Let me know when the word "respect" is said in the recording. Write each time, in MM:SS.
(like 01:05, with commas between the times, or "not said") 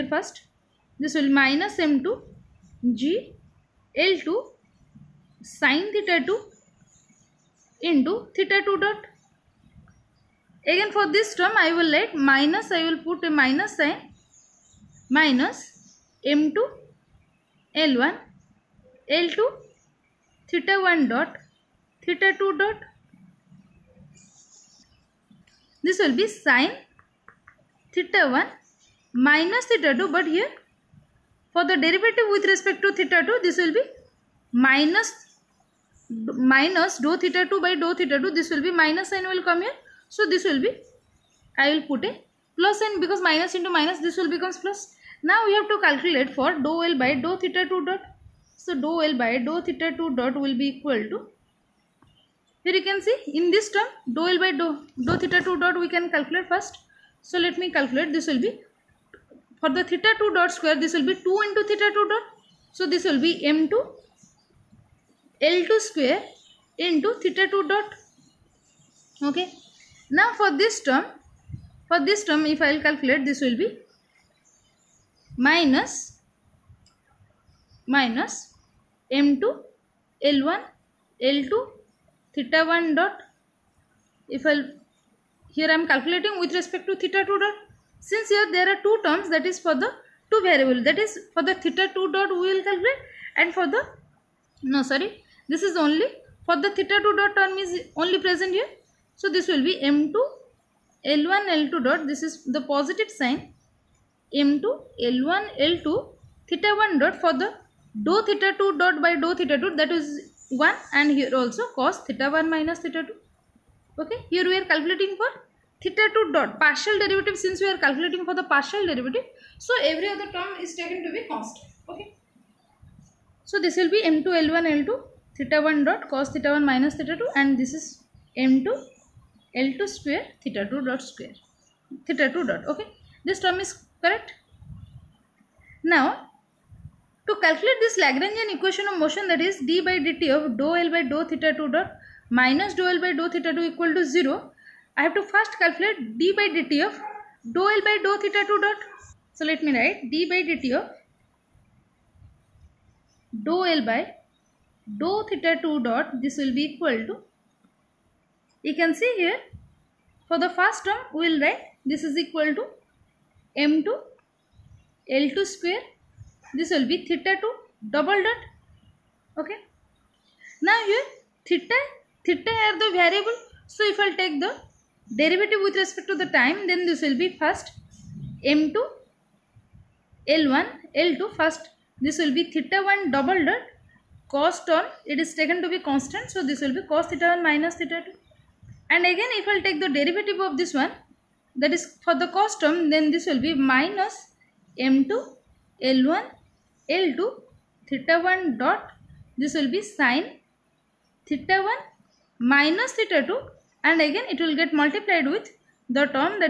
00:32, 01:26, 02:55.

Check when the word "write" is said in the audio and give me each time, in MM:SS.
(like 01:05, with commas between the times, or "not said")
02:29, 02:41.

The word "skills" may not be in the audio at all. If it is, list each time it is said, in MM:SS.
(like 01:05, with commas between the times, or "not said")
not said.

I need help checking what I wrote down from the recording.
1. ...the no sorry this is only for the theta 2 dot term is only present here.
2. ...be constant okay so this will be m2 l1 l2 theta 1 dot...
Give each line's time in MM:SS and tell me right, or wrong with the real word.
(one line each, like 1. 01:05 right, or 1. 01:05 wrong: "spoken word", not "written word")
1. 01:33 right
2. 02:01 right.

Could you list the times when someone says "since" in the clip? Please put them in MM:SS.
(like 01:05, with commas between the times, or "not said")
01:28, 01:57.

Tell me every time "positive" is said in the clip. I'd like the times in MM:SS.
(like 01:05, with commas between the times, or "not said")
01:42.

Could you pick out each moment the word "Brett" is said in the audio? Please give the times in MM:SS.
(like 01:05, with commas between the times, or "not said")
not said.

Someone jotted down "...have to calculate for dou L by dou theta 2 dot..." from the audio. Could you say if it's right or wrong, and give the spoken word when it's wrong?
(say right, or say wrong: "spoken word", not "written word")
right.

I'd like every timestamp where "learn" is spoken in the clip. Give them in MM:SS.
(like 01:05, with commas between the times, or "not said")
not said.